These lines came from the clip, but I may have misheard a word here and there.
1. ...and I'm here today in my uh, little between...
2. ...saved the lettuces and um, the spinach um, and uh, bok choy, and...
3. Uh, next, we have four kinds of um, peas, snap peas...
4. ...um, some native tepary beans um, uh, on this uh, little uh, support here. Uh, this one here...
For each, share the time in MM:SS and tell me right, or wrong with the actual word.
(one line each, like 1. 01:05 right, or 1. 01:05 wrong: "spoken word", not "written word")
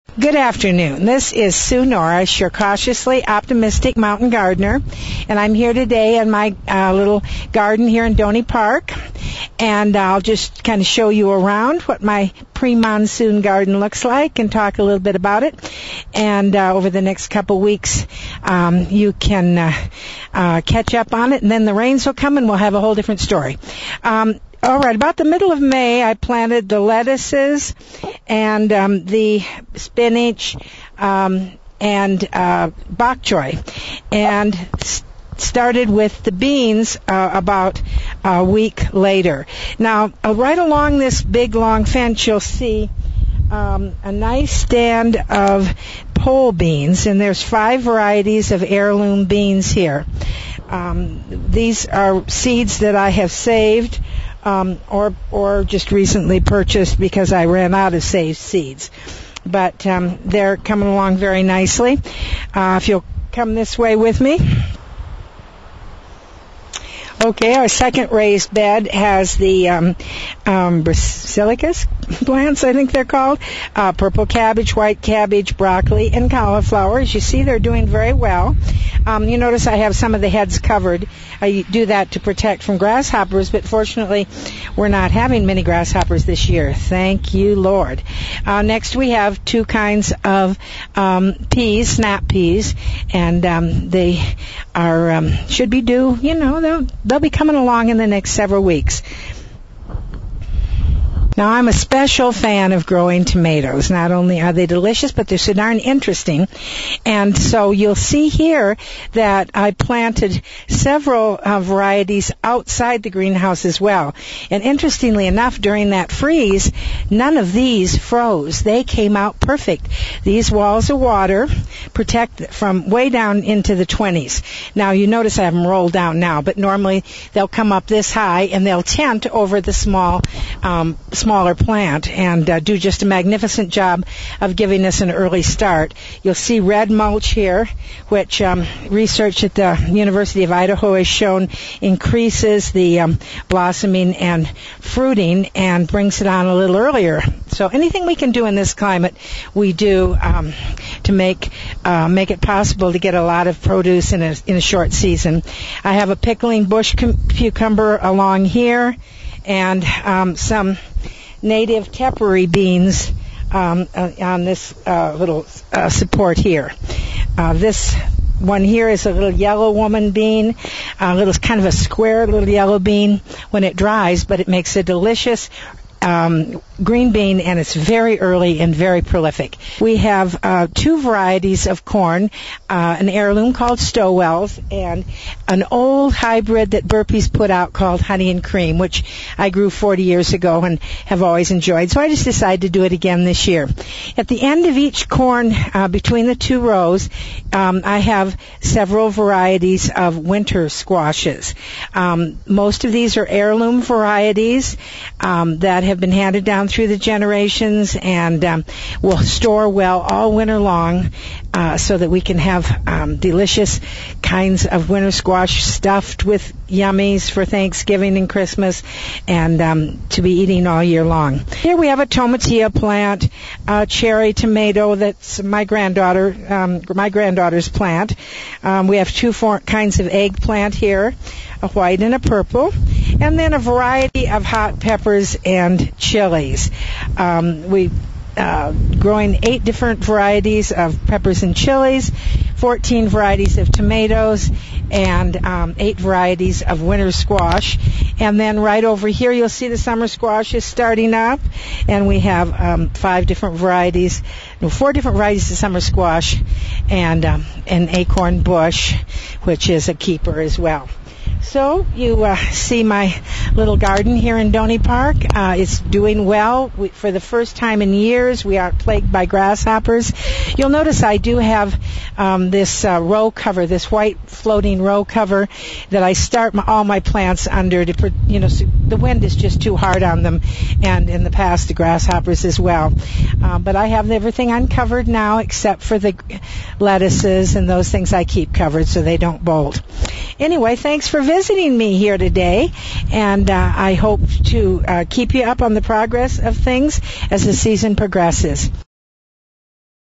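1. 00:05 wrong: "garden", not "between"
2. 00:26 wrong: "planted", not "saved"
3. 01:28 wrong: "two", not "four"
4. 02:40 right.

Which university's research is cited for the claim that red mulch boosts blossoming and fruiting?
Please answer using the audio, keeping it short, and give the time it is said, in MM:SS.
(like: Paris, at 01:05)
University of Idaho, at 02:19.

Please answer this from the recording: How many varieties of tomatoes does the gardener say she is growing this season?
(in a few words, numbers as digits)
14.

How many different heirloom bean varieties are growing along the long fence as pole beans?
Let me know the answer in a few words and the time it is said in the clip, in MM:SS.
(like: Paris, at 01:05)
5, at 00:47.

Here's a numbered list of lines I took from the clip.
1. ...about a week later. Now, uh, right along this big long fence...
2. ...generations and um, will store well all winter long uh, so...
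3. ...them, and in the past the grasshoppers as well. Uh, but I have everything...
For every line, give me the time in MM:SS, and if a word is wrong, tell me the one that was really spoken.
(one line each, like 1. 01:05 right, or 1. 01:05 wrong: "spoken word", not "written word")
1. 00:37 right
2. 03:26 right
3. 04:40 right.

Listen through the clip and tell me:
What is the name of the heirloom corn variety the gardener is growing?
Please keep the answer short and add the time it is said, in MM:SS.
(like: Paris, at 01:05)
Stowell's, at 03:03.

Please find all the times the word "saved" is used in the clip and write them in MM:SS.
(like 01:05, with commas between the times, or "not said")
00:53, 00:58.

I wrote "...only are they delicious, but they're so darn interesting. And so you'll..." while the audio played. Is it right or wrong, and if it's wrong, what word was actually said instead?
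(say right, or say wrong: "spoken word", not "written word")
right.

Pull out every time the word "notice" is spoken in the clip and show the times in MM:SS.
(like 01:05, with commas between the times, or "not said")
01:19, 02:05, 04:30.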